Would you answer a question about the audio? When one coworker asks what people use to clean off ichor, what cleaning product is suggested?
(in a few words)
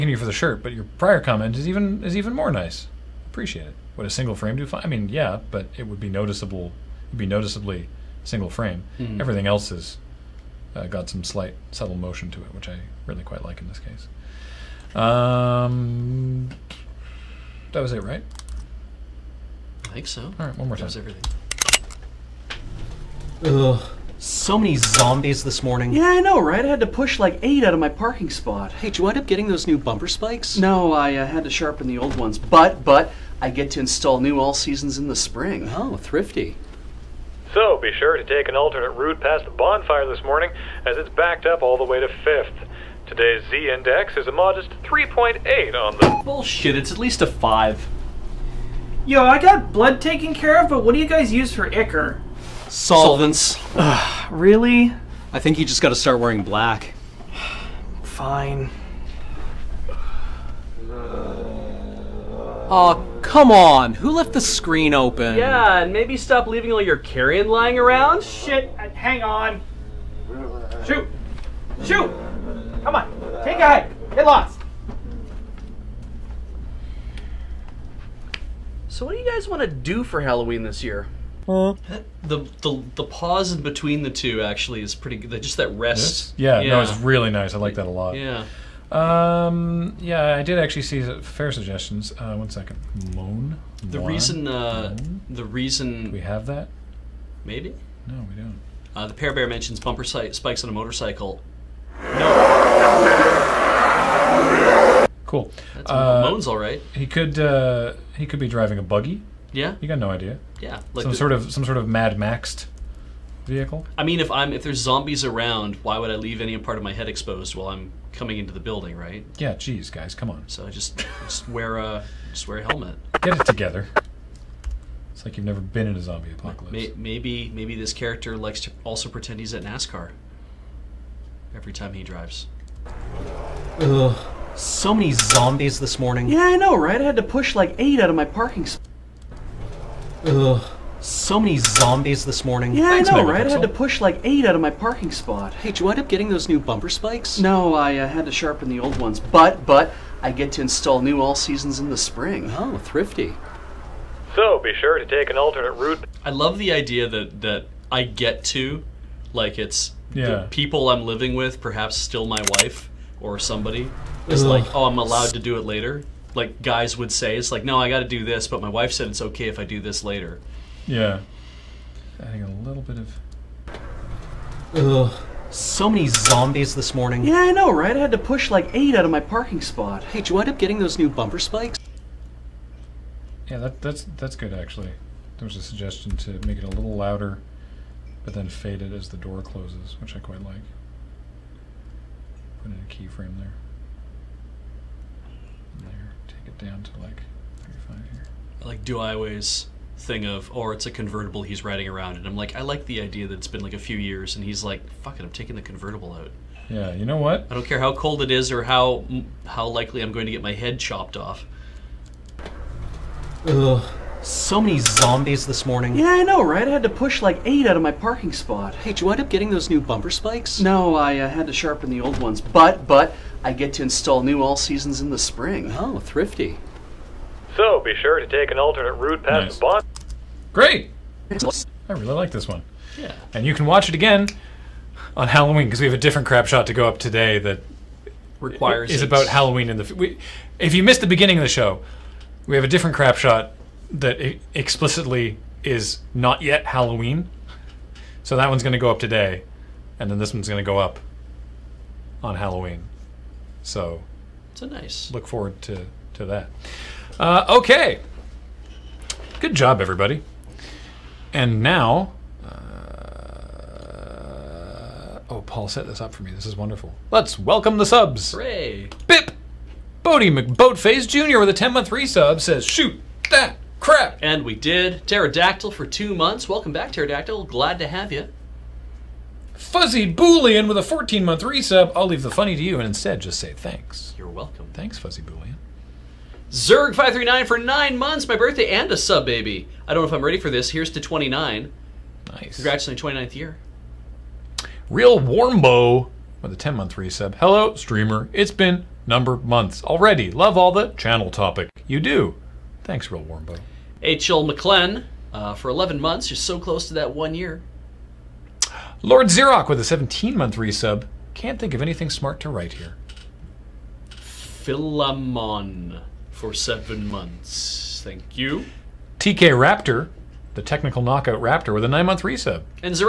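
Solvents.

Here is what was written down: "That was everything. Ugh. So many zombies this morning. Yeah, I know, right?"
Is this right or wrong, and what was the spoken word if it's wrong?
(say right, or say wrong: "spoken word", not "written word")
right.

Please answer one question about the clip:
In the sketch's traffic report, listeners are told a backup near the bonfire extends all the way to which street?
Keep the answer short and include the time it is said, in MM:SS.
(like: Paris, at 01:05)
5th, at 00:42.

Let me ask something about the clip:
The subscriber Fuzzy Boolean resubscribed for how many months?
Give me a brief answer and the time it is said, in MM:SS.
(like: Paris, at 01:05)
14, at 04:40.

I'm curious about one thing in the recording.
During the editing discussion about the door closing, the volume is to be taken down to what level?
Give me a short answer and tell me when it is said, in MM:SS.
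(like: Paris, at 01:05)
35, at 03:17.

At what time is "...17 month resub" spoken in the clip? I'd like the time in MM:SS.
05:09.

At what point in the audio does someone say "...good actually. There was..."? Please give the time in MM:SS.
03:04.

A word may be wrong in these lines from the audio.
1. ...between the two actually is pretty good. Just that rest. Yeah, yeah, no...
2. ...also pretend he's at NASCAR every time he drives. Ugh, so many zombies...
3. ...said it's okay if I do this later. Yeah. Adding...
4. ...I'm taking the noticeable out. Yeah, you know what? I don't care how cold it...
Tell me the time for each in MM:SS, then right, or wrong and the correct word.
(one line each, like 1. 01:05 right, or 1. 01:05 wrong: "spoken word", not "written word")
1. 01:23 right
2. 02:08 right
3. 02:48 right
4. 03:25 wrong: "convertible", not "noticeable".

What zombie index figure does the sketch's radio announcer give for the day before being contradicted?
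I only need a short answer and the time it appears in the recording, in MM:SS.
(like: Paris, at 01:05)
3.8, at 00:44.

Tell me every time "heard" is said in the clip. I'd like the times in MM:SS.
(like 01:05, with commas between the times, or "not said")
not said.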